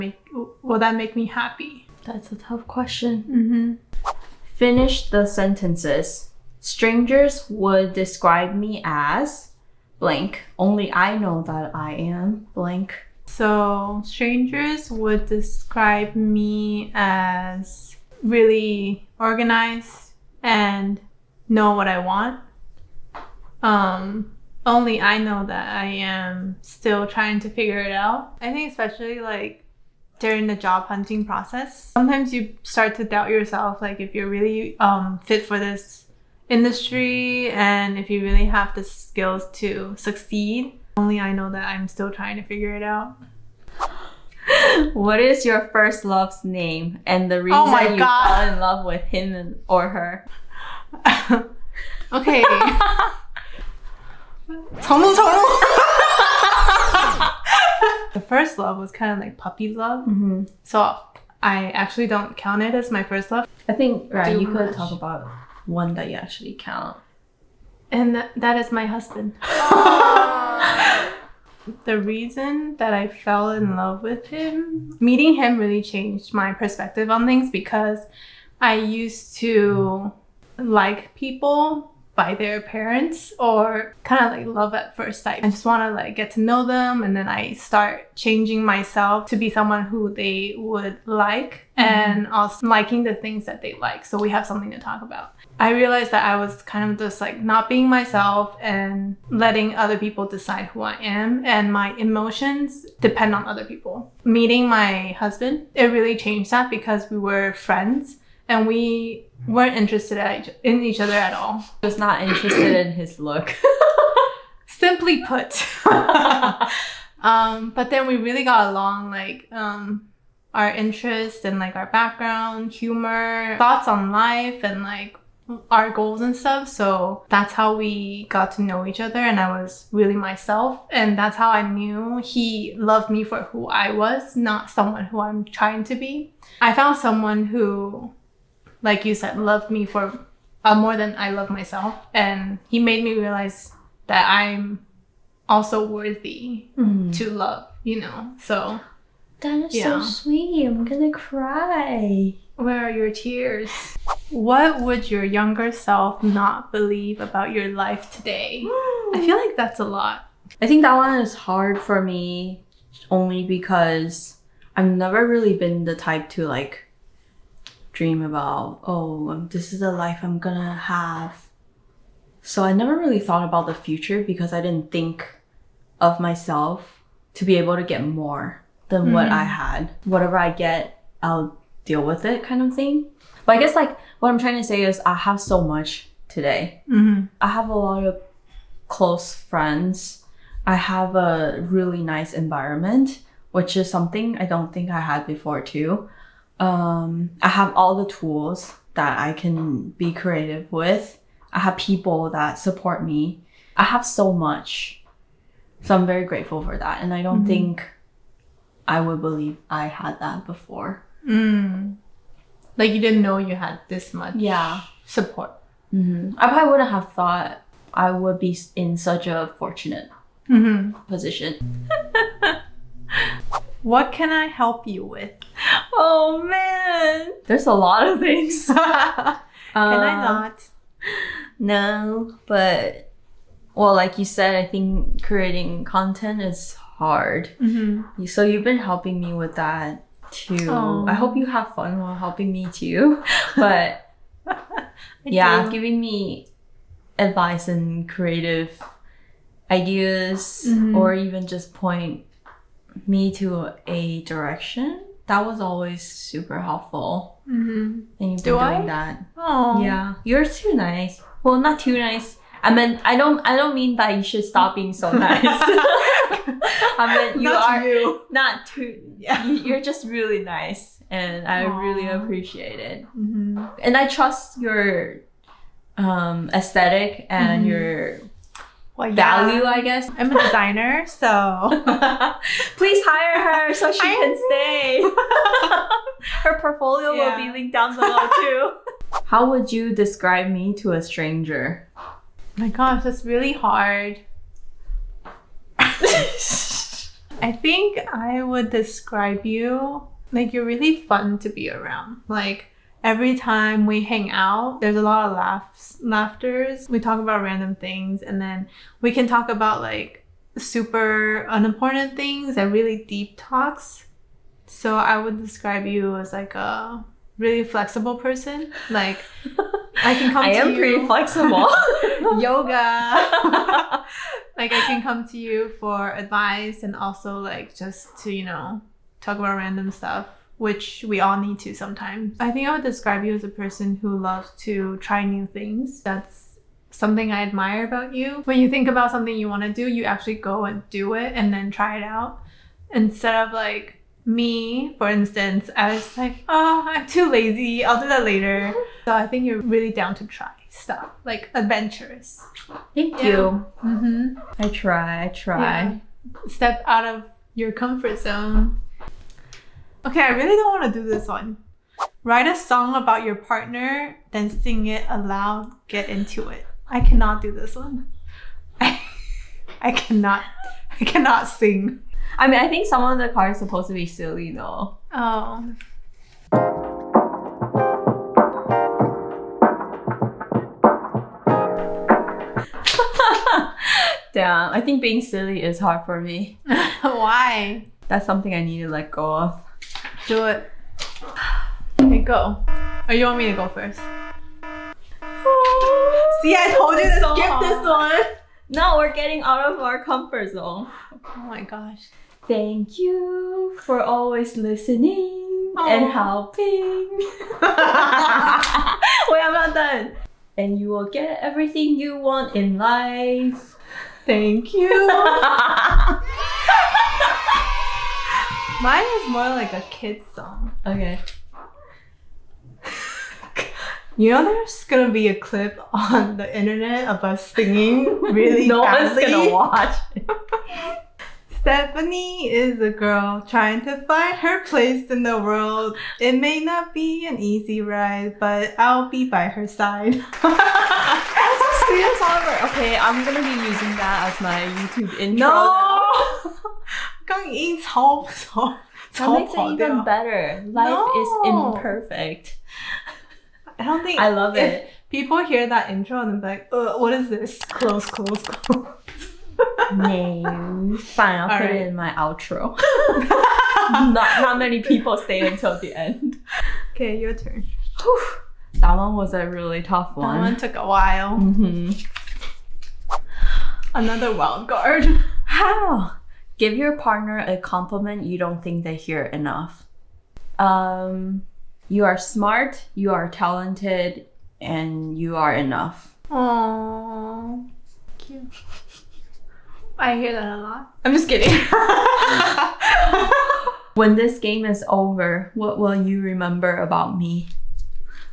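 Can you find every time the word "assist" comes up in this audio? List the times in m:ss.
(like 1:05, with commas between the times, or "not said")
not said.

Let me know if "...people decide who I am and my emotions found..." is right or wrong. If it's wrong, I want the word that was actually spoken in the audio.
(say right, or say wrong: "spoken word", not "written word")
wrong: "depend", not "found".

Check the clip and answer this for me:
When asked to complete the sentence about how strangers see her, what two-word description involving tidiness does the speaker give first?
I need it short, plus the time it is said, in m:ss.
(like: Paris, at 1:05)
Really organized, at 0:18.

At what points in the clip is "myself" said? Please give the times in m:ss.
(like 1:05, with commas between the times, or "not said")
1:28, 1:37, 2:10, 2:21, 2:56.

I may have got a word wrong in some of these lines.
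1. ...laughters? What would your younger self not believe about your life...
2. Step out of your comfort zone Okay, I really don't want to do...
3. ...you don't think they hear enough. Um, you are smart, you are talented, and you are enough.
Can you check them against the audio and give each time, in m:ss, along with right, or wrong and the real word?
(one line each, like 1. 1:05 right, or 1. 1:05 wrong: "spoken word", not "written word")
1. 2:33 wrong: "tears", not "laughters"
2. 5:56 right
3. 7:58 right.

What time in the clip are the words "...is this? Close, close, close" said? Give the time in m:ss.
7:37.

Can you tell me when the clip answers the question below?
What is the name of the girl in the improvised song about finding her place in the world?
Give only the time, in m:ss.
7:11.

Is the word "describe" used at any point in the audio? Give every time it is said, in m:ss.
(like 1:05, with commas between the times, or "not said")
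0:07, 0:15, 4:49, 4:58, 5:15, 5:32.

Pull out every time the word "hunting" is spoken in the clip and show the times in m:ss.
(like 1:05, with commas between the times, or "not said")
0:30.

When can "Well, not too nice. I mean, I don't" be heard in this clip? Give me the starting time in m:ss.
4:21.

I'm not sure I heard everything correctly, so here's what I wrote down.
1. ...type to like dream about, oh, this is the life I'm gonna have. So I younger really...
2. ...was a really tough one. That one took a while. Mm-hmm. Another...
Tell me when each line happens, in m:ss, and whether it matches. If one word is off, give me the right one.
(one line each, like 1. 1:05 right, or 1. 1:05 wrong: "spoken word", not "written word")
1. 2:45 wrong: "never", not "younger"
2. 7:49 right.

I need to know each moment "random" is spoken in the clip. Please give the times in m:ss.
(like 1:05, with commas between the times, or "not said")
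5:07, 5:29.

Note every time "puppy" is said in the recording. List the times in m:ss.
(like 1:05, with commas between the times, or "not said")
0:59.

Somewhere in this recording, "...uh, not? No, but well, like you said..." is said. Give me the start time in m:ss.
3:49.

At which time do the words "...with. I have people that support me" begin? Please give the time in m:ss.
3:20.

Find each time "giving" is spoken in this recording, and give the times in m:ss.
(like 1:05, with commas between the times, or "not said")
4:05.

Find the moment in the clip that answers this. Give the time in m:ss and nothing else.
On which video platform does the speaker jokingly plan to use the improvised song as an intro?
7:24.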